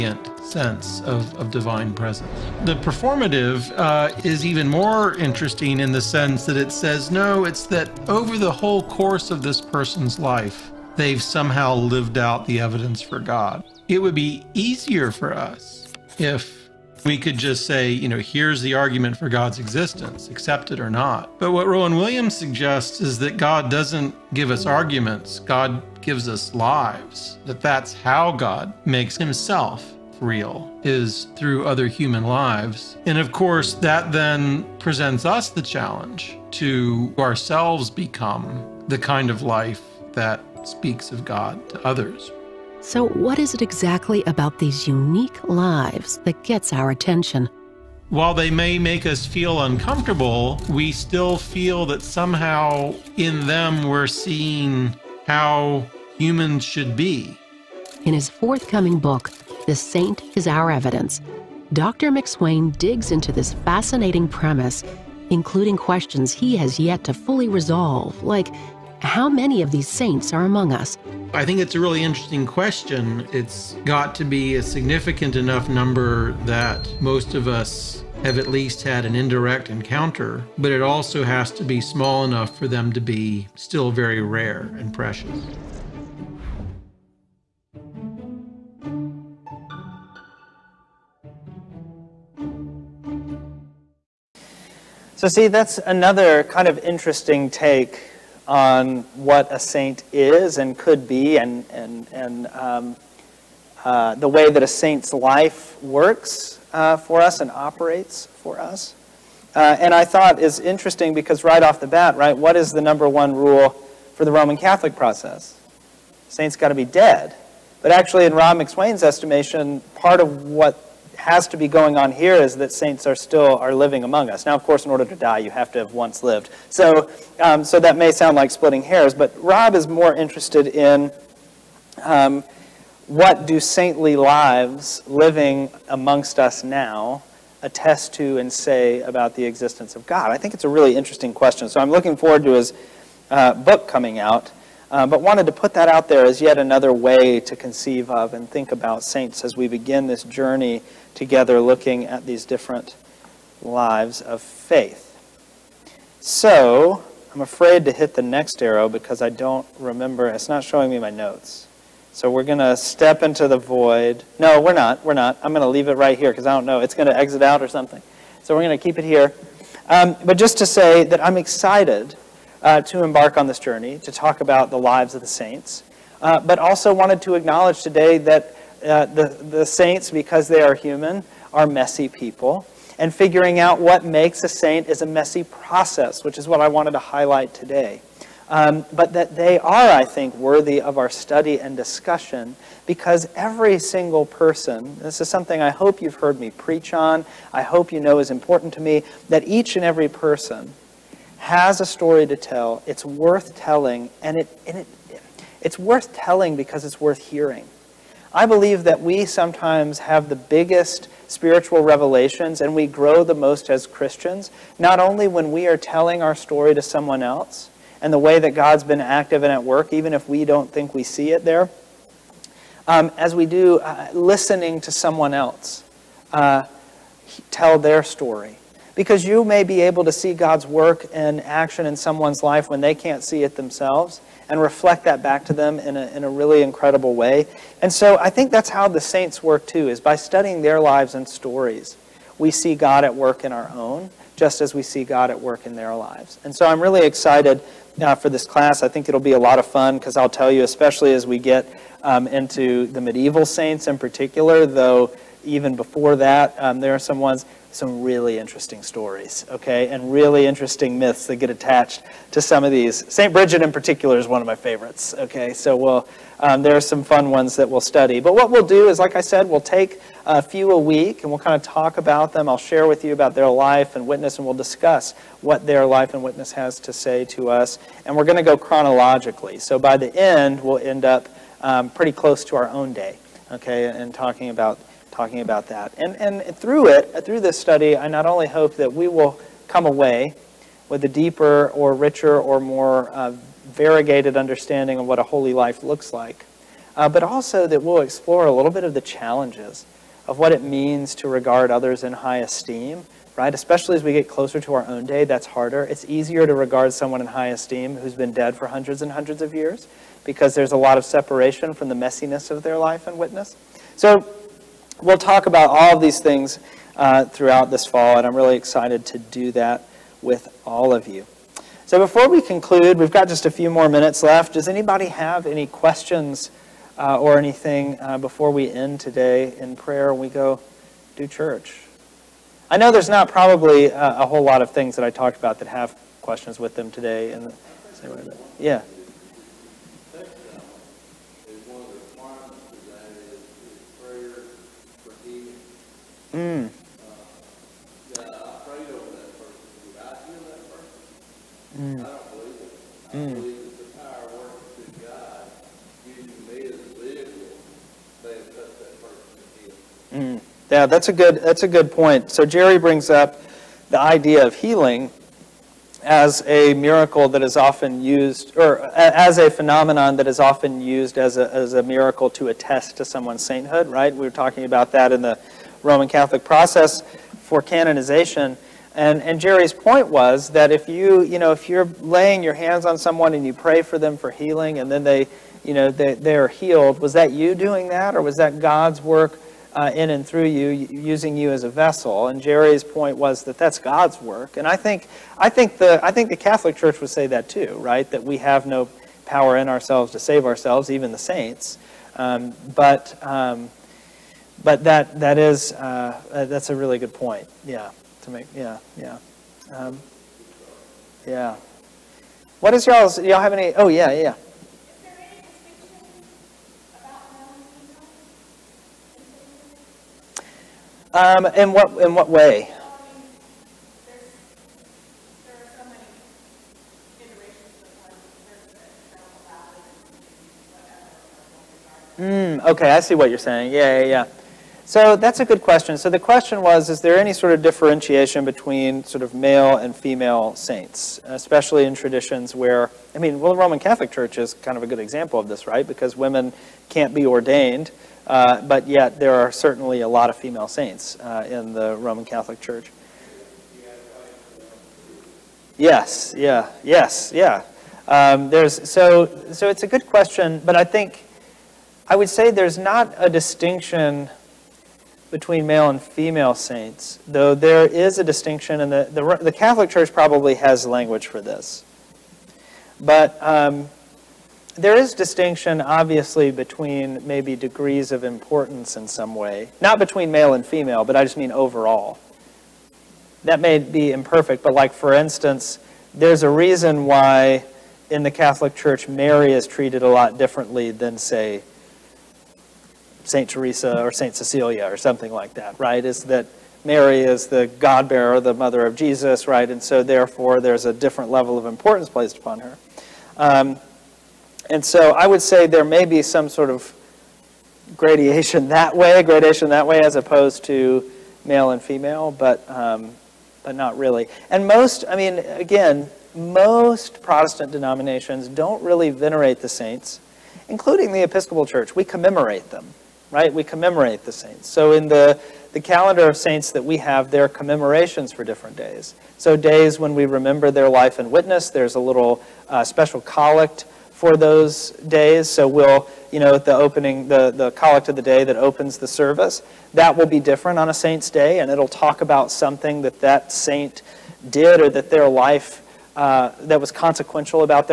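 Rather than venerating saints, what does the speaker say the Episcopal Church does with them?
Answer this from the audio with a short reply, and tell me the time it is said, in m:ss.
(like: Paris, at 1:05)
Commemorate them, at 8:41.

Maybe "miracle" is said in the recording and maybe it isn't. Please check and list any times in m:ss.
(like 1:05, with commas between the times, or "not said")
6:06, 6:11.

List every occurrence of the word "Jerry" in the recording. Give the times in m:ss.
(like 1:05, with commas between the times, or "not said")
6:02, 6:19, 6:32.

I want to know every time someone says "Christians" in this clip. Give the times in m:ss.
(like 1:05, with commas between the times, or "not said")
3:33.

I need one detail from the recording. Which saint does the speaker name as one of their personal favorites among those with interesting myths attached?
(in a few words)
St. Bridget.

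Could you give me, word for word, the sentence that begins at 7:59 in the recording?
Not between male and female, but I just mean overall.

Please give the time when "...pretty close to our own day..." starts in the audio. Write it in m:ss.
4:41.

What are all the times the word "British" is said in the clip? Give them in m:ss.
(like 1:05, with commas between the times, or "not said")
not said.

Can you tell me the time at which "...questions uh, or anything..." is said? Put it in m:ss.
5:25.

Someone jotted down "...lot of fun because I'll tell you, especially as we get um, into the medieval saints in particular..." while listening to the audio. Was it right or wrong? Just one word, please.
right.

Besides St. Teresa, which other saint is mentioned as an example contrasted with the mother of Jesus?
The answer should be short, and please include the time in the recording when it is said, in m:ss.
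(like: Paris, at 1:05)
St. Cecilia, at 8:14.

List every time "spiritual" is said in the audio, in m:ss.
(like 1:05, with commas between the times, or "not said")
3:31.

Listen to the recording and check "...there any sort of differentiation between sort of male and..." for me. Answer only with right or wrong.
right.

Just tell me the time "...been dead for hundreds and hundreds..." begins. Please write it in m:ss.
5:08.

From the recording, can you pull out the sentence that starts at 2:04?
Now, of course, in order to die, you have to have once lived.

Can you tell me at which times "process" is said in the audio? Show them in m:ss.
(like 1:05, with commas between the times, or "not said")
1:54, 3:05, 6:16.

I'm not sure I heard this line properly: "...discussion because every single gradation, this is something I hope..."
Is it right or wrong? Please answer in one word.
wrong.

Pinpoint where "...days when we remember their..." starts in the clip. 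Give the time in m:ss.
8:49.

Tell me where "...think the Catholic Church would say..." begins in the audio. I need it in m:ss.
6:36.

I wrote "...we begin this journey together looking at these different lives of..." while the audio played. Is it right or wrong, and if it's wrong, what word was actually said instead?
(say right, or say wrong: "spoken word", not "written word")
right.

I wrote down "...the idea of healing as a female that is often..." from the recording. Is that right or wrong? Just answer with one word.
wrong.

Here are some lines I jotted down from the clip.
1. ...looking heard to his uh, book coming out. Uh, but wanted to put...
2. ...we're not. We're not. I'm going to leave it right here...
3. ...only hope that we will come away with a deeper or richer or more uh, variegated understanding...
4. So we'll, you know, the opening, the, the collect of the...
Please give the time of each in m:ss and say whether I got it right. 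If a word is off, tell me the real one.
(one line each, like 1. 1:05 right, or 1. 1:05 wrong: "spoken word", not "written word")
1. 2:21 wrong: "forward", not "heard"
2. 2:44 right
3. 4:48 right
4. 8:55 right.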